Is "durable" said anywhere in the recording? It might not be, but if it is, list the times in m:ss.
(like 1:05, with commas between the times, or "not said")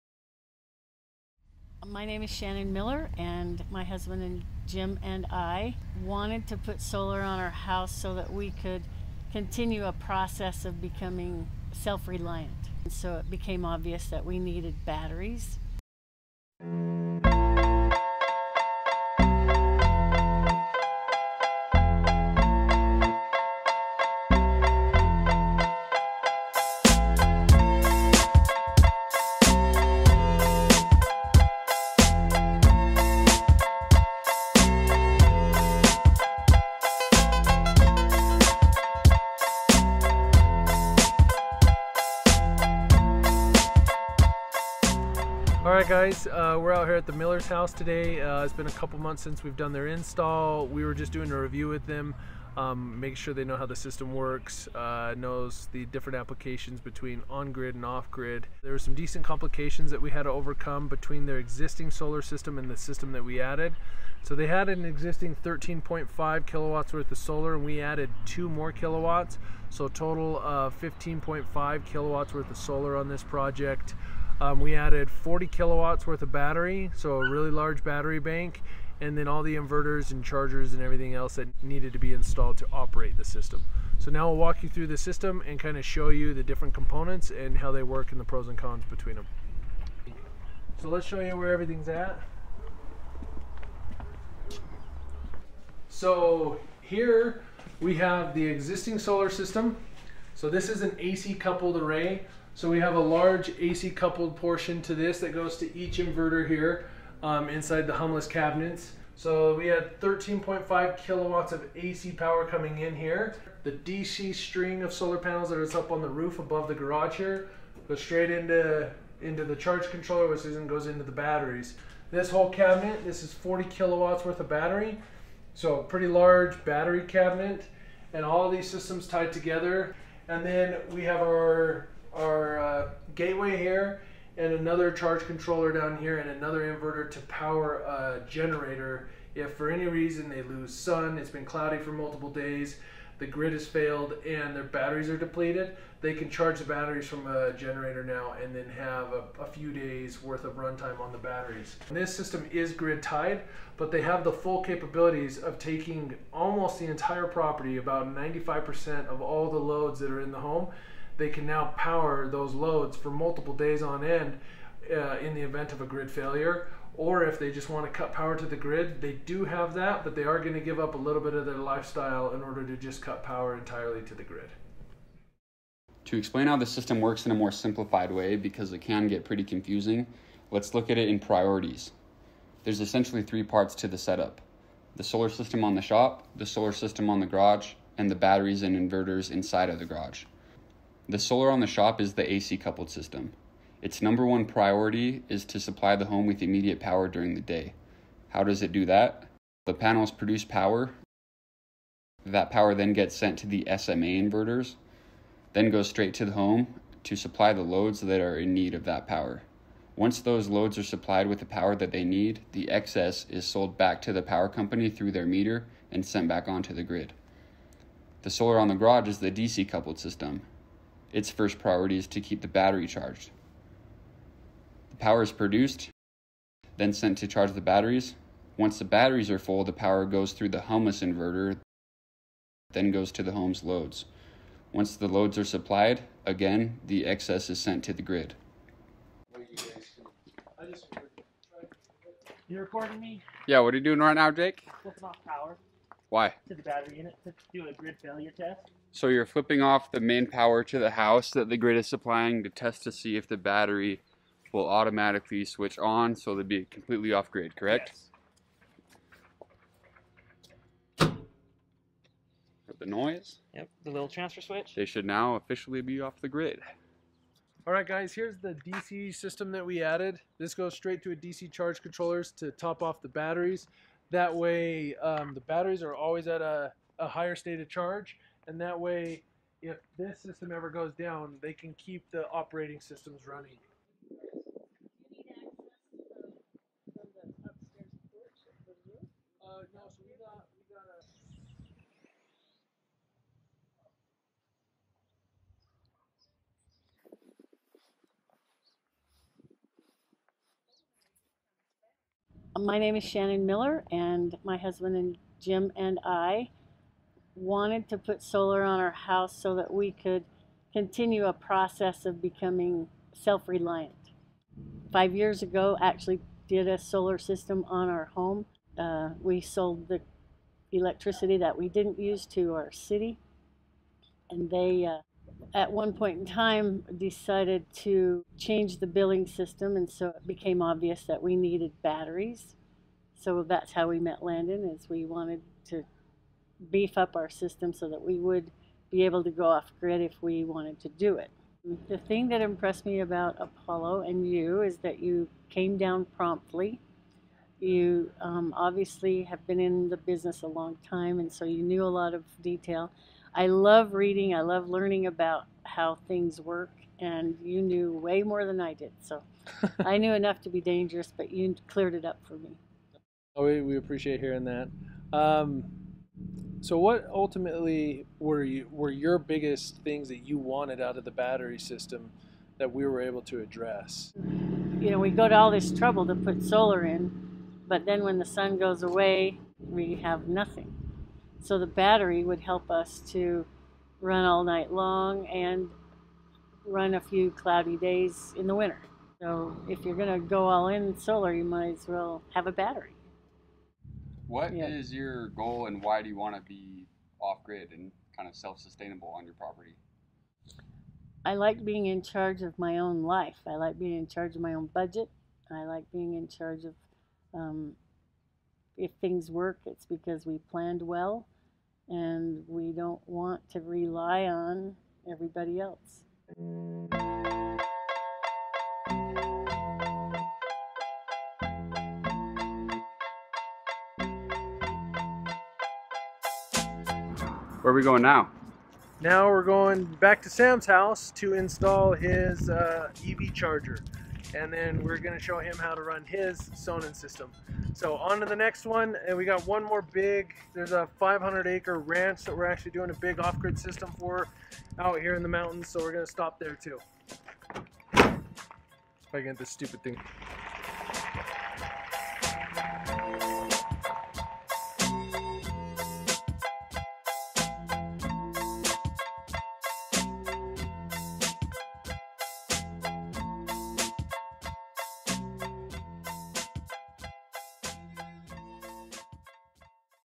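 not said.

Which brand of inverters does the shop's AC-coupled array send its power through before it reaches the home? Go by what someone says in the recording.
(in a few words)
SMA.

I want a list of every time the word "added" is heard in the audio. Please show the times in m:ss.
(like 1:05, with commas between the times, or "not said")
1:03, 1:07, 1:14, 4:29.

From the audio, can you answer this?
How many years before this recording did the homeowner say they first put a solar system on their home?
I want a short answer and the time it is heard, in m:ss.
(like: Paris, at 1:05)
5, at 5:14.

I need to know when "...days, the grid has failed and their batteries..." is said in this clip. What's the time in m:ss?
2:22.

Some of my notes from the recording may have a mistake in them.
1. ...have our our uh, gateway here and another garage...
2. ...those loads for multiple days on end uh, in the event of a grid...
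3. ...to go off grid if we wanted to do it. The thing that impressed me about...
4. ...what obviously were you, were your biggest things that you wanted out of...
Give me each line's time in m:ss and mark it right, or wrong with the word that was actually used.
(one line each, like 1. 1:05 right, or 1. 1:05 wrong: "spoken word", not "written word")
1. 2:11 wrong: "charge", not "garage"
2. 2:42 right
3. 5:39 right
4. 6:06 wrong: "ultimately", not "obviously".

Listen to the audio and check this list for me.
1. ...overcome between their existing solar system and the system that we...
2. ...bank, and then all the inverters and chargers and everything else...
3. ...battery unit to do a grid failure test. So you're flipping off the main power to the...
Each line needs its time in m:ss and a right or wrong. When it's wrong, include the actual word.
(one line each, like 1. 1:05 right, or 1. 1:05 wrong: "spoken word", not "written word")
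1. 1:00 right
2. 1:18 right
3. 4:06 right.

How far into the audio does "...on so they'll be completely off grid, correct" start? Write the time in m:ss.
4:15.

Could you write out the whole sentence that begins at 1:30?
So let's show you where everything's at.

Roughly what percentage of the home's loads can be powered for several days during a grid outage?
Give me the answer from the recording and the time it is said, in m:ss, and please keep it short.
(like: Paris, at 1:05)
95%, at 2:38.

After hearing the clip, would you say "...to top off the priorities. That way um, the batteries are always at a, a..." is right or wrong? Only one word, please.
wrong.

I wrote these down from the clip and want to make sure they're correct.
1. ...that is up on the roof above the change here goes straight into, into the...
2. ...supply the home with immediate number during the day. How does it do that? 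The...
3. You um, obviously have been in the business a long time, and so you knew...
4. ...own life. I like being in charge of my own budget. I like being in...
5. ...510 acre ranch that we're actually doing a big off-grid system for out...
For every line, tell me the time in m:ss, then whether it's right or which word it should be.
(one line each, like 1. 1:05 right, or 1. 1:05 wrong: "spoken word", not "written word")
1. 1:55 wrong: "garage", not "change"
2. 3:15 wrong: "power", not "number"
3. 5:47 right
4. 6:42 right
5. 7:20 wrong: "500", not "510".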